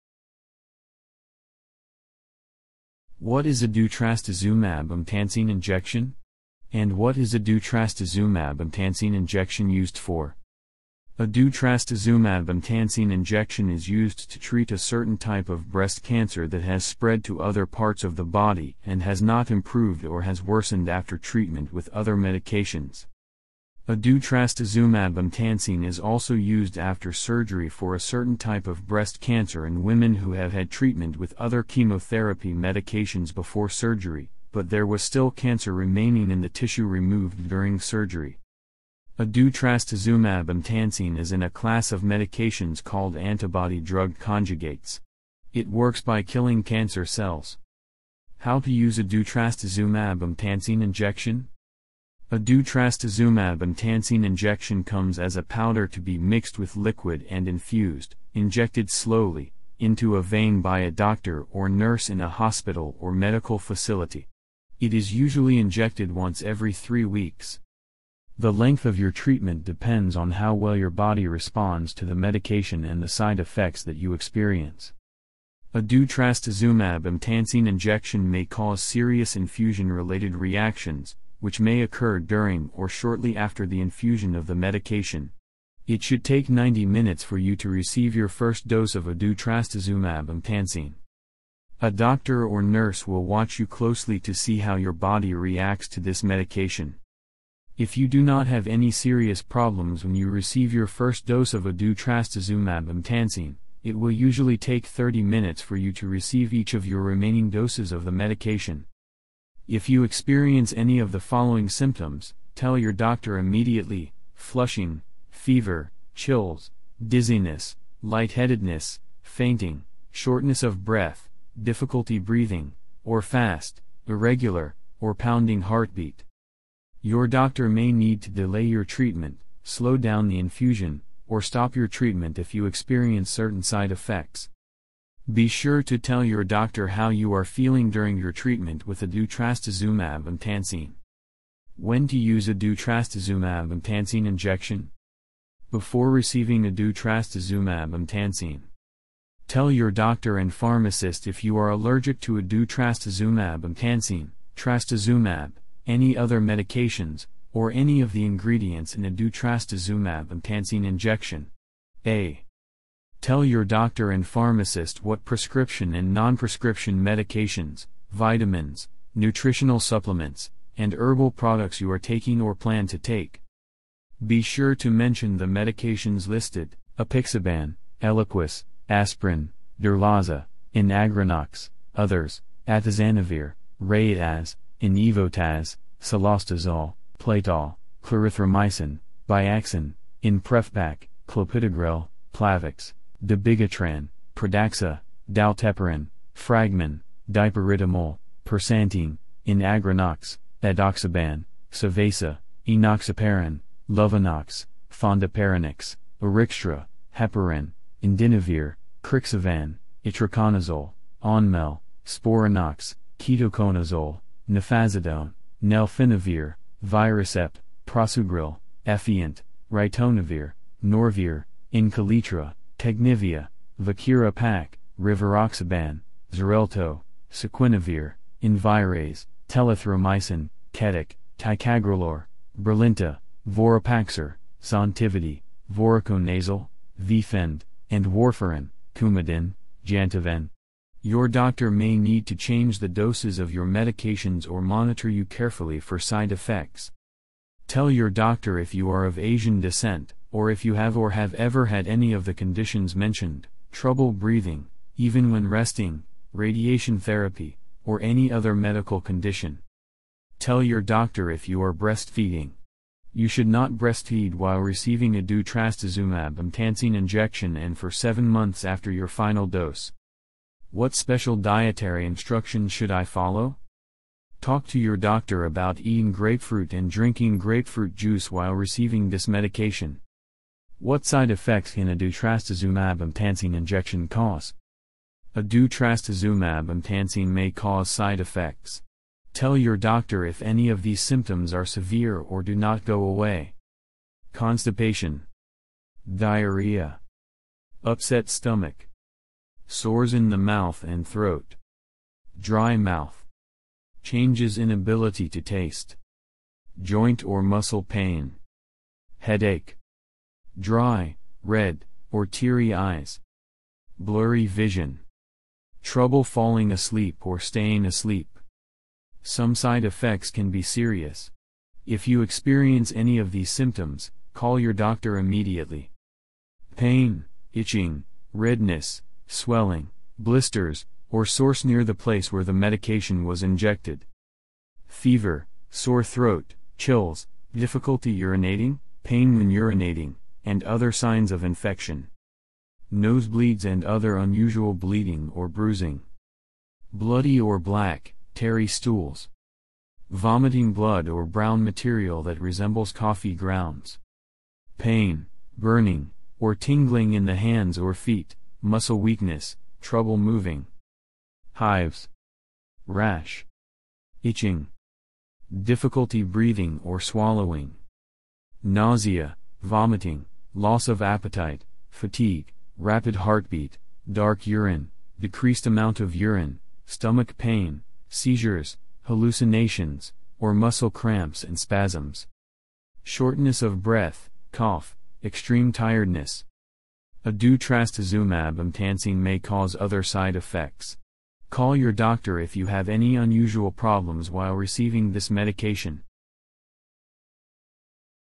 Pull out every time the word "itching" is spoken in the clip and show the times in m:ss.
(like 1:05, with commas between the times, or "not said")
5:27, 6:04.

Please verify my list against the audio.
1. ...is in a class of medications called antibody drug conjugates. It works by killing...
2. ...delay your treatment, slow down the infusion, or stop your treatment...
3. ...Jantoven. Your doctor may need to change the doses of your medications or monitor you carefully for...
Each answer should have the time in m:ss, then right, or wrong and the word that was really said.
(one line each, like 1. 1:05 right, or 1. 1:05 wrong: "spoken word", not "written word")
1. 0:41 right
2. 2:08 right
3. 3:59 right.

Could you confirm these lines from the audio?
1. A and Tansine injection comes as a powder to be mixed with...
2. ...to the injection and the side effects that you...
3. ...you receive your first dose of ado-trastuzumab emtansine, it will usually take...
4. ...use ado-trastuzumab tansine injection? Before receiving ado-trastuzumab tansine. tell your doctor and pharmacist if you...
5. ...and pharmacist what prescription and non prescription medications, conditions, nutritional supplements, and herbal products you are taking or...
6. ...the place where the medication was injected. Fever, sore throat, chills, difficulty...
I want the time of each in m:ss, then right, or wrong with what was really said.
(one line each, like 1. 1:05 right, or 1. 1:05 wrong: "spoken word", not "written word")
1. 0:52 right
2. 1:11 wrong: "medication", not "injection"
3. 1:40 right
4. 2:22 right
5. 2:44 wrong: "vitamins", not "conditions"
6. 5:31 right.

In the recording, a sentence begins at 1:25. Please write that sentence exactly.
It should take 90 minutes for you to receive your first dose of ado-trastuzumab emtansine.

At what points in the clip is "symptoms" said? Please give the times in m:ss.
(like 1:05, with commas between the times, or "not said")
1:51, 4:50, 5:23.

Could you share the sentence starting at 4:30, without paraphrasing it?
What special dietary instructions should I follow?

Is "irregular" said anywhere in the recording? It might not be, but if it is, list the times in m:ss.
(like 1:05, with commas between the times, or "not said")
2:04.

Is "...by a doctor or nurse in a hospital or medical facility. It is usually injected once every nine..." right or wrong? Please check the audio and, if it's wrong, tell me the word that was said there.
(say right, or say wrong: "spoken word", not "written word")
wrong: "three", not "nine".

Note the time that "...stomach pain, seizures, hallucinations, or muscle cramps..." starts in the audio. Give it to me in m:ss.
6:16.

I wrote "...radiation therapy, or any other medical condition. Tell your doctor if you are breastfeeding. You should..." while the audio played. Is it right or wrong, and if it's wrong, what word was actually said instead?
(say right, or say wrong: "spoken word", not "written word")
right.